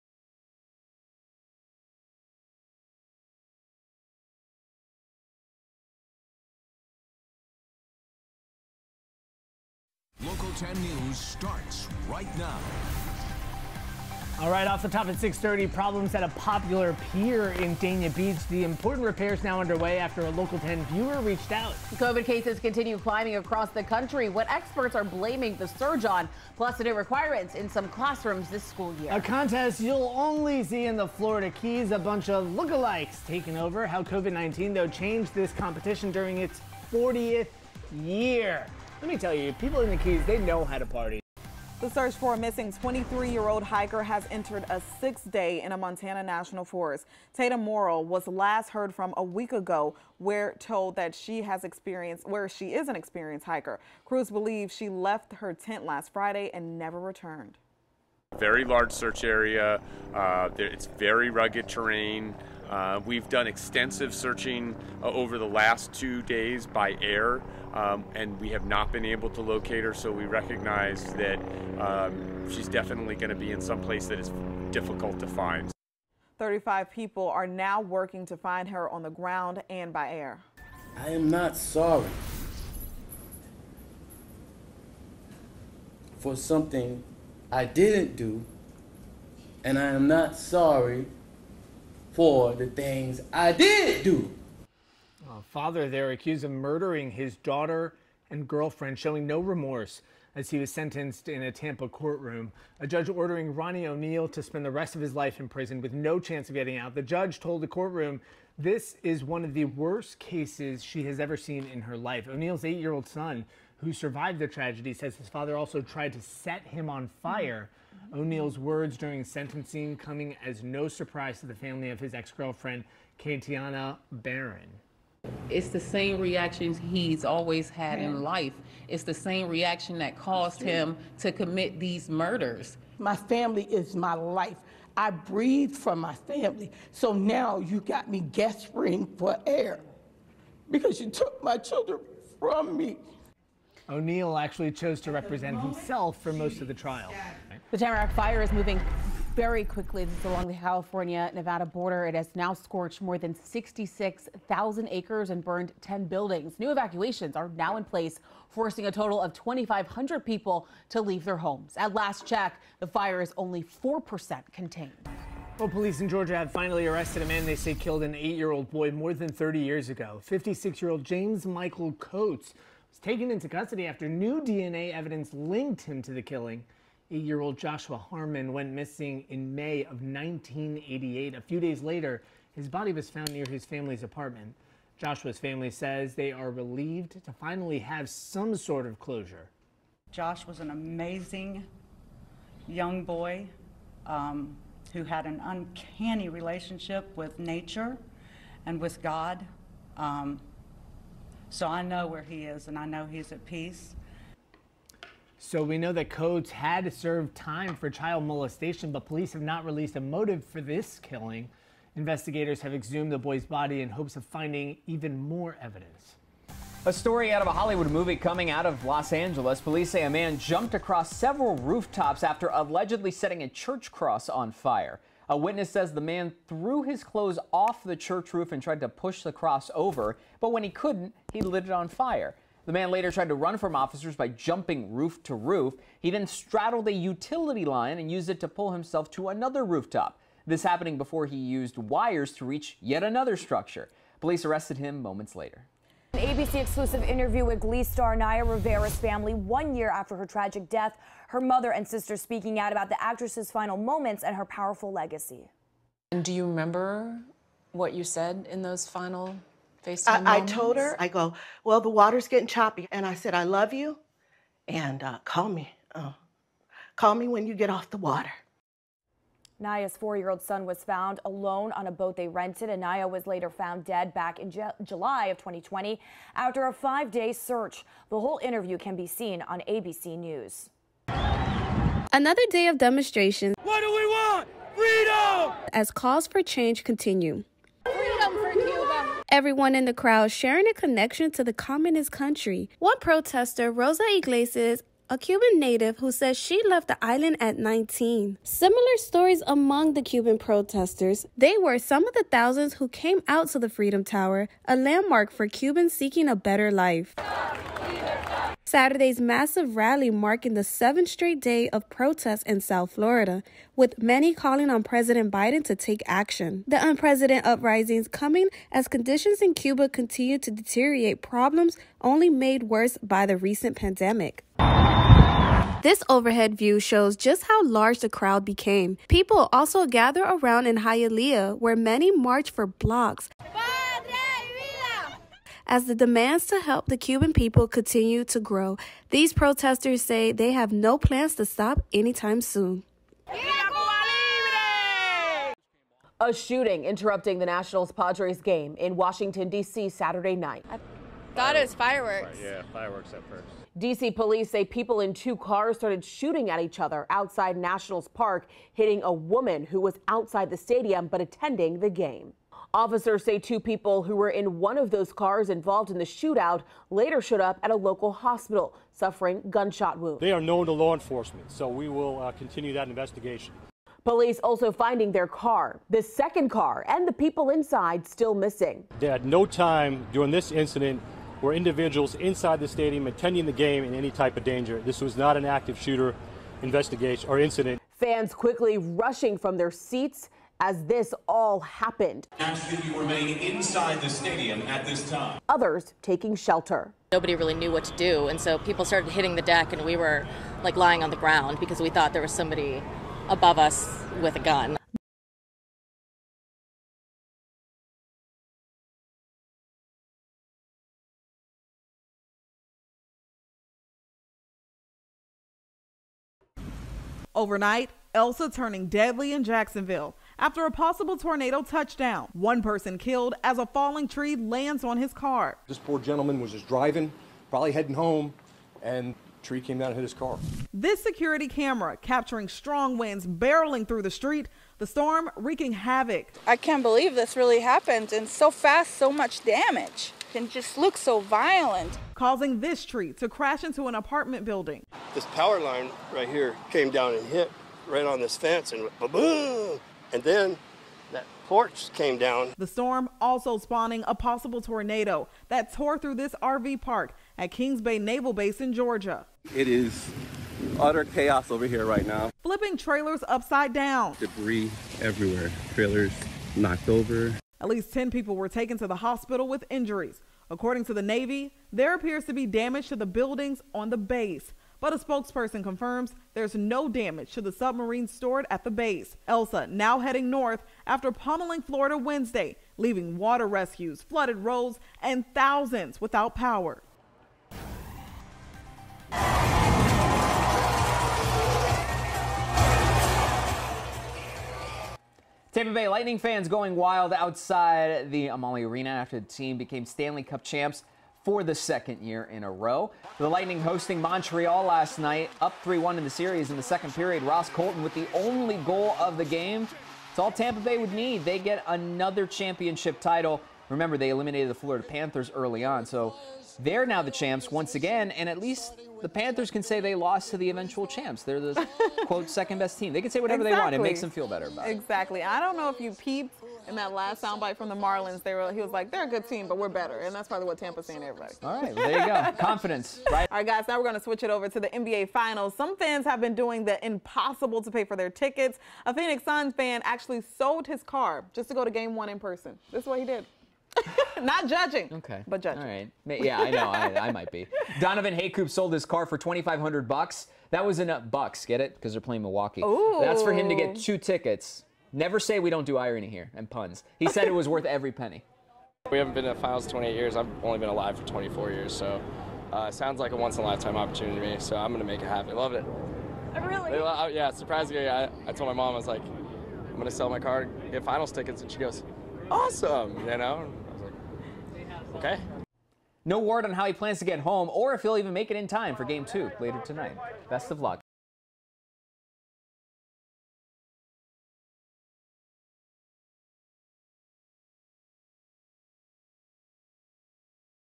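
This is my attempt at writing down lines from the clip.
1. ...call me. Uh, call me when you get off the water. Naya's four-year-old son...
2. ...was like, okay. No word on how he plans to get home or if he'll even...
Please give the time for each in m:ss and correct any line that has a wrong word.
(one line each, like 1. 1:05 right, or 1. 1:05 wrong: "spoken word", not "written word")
1. 4:25 right
2. 9:33 right.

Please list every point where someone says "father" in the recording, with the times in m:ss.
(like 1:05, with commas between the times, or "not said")
1:35, 1:55.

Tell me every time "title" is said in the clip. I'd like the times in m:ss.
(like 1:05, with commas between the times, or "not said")
8:33.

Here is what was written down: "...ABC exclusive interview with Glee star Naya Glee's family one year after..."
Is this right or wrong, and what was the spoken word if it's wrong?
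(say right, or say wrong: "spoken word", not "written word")
wrong: "Rivera", not "Glee".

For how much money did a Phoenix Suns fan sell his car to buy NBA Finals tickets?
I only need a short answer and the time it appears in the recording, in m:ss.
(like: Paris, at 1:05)
$2,500, at 9:09.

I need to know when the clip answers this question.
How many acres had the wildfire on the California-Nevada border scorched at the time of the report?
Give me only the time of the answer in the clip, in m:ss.
2:33.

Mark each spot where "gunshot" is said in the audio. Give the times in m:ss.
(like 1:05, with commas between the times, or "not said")
6:09.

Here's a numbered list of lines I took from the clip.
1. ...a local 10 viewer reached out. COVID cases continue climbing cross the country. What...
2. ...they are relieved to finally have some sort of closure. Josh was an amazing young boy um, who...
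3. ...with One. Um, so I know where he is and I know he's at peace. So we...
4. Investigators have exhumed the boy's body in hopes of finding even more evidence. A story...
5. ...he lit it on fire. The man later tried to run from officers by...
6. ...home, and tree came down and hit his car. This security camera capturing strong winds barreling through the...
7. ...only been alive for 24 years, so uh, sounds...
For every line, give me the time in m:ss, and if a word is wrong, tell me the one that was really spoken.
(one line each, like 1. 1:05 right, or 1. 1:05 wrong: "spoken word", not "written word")
1. 0:20 wrong: "across", not "cross"
2. 3:06 right
3. 3:18 wrong: "God", not "One"
4. 3:31 right
5. 3:51 right
6. 7:07 right
7. 9:20 right.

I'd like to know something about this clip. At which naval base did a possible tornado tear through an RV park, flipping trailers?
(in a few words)
Kings Bay Naval Base.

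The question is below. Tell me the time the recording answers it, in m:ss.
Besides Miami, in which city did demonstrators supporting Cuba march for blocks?
5:30.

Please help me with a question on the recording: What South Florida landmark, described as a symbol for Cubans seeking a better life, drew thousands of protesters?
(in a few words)
Freedom Tower.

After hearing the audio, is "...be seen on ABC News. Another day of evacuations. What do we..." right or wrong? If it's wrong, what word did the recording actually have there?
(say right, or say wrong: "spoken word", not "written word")
wrong: "demonstrations", not "evacuations".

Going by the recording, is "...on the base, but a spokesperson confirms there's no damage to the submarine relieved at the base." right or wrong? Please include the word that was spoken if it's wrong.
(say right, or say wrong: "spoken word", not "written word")
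wrong: "stored", not "relieved".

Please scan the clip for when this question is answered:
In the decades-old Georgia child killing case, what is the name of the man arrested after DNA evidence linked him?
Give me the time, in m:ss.
2:51.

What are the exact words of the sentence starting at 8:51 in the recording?
All right, well, there you go.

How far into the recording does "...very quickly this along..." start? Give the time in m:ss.
2:29.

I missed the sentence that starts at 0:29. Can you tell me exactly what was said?
A contest you'll only see in the Florida Keys.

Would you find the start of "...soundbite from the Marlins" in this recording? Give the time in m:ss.
8:47.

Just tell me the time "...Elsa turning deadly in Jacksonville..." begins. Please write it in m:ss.
6:58.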